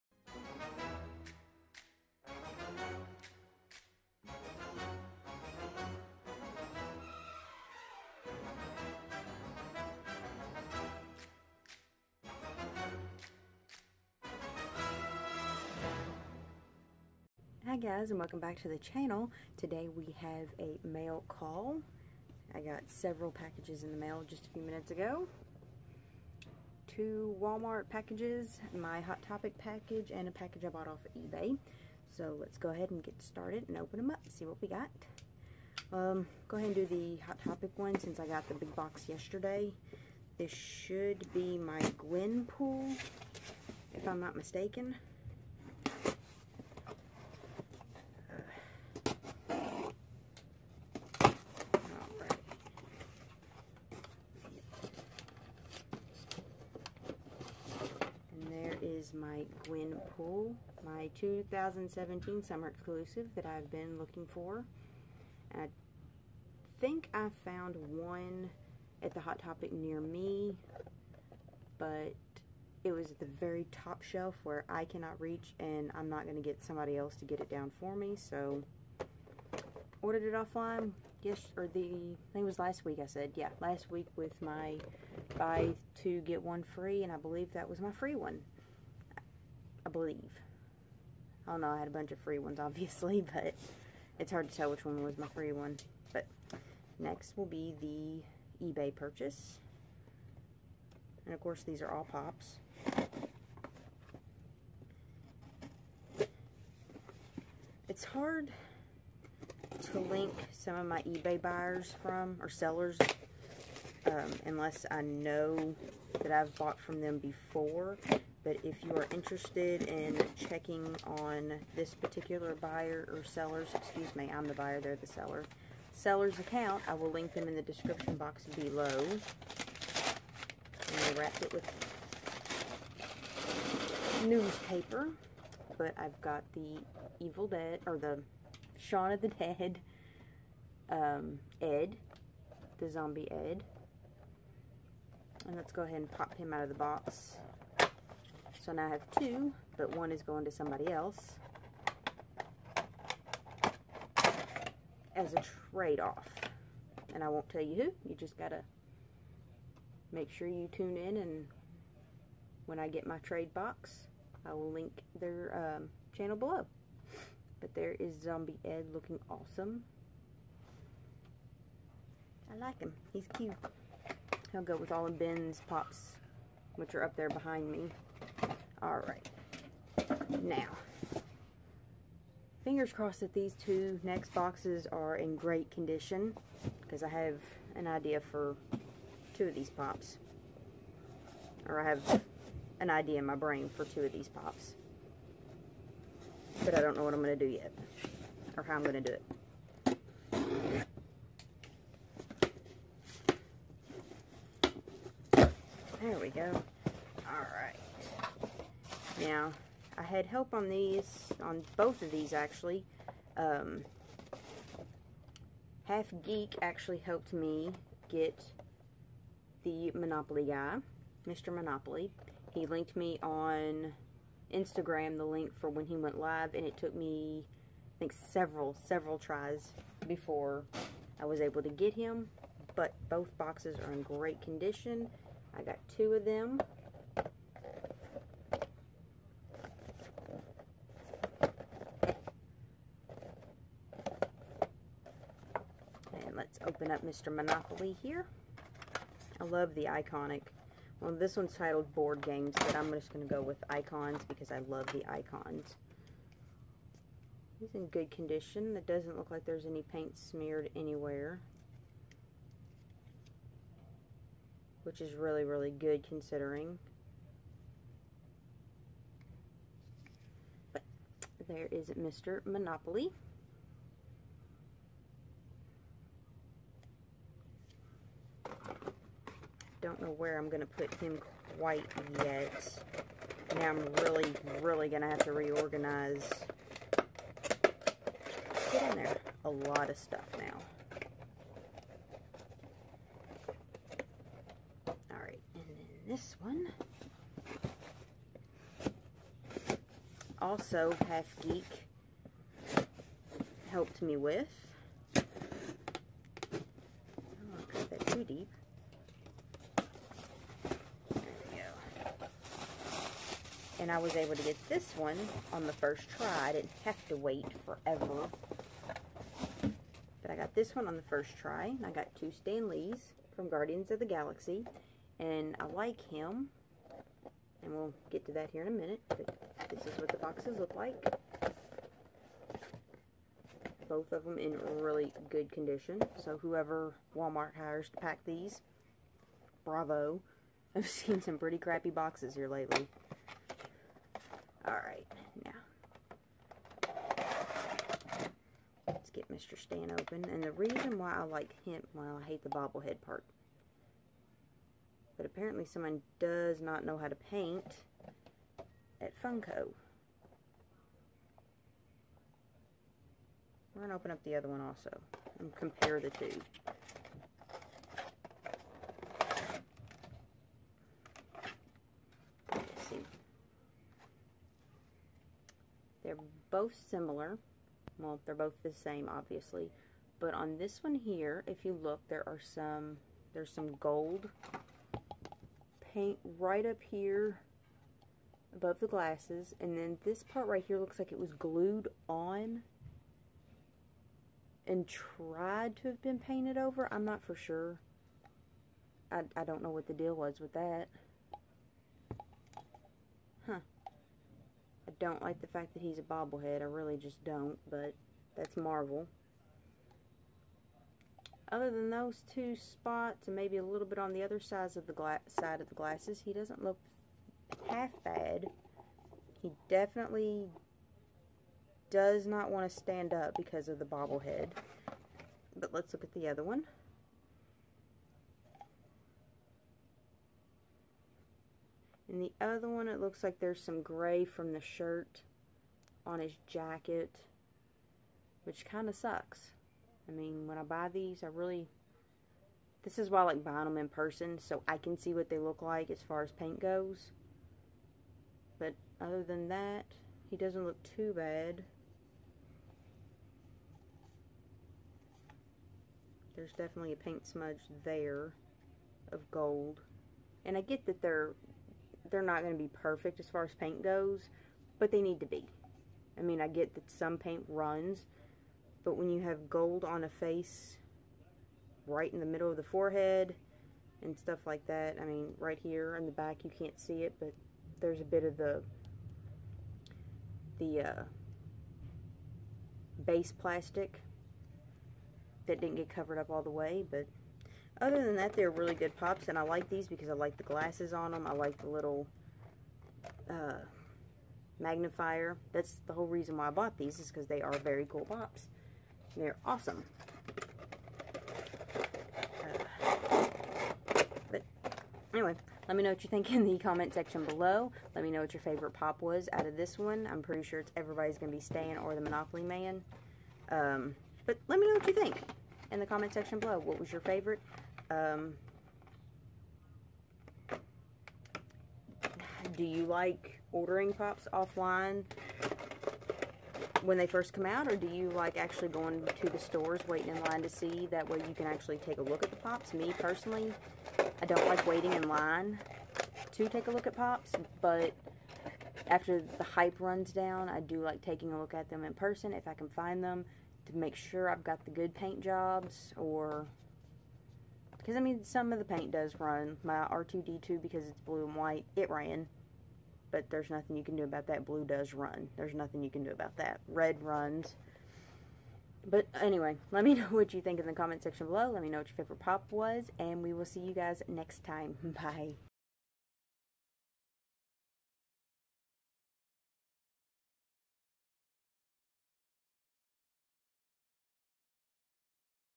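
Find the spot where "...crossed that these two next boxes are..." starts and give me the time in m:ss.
3:02.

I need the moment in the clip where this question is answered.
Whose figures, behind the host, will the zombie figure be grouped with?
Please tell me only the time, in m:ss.
2:55.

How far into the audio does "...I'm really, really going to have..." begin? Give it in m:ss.
4:43.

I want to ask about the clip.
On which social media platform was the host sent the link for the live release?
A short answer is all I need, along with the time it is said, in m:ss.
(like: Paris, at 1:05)
Instagram, at 3:44.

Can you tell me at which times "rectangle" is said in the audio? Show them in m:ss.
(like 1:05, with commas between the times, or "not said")
not said.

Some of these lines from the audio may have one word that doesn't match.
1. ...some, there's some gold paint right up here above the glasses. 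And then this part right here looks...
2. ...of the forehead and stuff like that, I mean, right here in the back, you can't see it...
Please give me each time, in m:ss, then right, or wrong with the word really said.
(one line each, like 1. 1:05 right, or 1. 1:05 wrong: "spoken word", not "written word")
1. 6:22 right
2. 7:52 right.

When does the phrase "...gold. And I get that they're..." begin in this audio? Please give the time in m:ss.
7:39.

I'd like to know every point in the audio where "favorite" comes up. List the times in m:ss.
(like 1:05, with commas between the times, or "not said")
8:28, 8:37, 9:21.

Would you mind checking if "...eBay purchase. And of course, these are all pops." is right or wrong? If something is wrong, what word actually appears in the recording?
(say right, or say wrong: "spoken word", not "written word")
right.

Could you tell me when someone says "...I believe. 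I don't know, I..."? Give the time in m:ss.
1:29.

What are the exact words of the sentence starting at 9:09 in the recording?
My R2-D2, because it's blue and white, it ran.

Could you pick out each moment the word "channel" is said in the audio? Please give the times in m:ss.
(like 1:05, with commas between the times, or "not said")
0:18, 2:46.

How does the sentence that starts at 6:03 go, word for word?
We're going to open up the other one also and compare the two.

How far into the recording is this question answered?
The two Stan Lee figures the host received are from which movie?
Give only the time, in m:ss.
5:23.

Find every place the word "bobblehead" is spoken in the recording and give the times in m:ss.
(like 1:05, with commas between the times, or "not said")
5:52, 6:46, 7:03.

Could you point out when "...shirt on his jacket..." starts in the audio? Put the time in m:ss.
7:14.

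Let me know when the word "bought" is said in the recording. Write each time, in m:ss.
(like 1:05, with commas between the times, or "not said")
0:30, 1:56, 8:16.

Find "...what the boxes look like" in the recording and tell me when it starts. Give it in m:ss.
5:29.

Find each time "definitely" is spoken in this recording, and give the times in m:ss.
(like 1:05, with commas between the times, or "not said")
6:59, 7:36.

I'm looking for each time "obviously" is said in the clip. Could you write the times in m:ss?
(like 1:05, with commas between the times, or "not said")
1:32, 6:19.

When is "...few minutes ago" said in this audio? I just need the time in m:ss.
0:24.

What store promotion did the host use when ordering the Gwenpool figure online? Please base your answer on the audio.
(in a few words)
buy two get one free.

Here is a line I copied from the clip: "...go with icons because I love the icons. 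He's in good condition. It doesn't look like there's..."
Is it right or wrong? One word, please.
right.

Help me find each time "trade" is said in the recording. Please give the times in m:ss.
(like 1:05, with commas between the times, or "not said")
2:35, 2:43.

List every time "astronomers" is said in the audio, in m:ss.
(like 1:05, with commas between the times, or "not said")
not said.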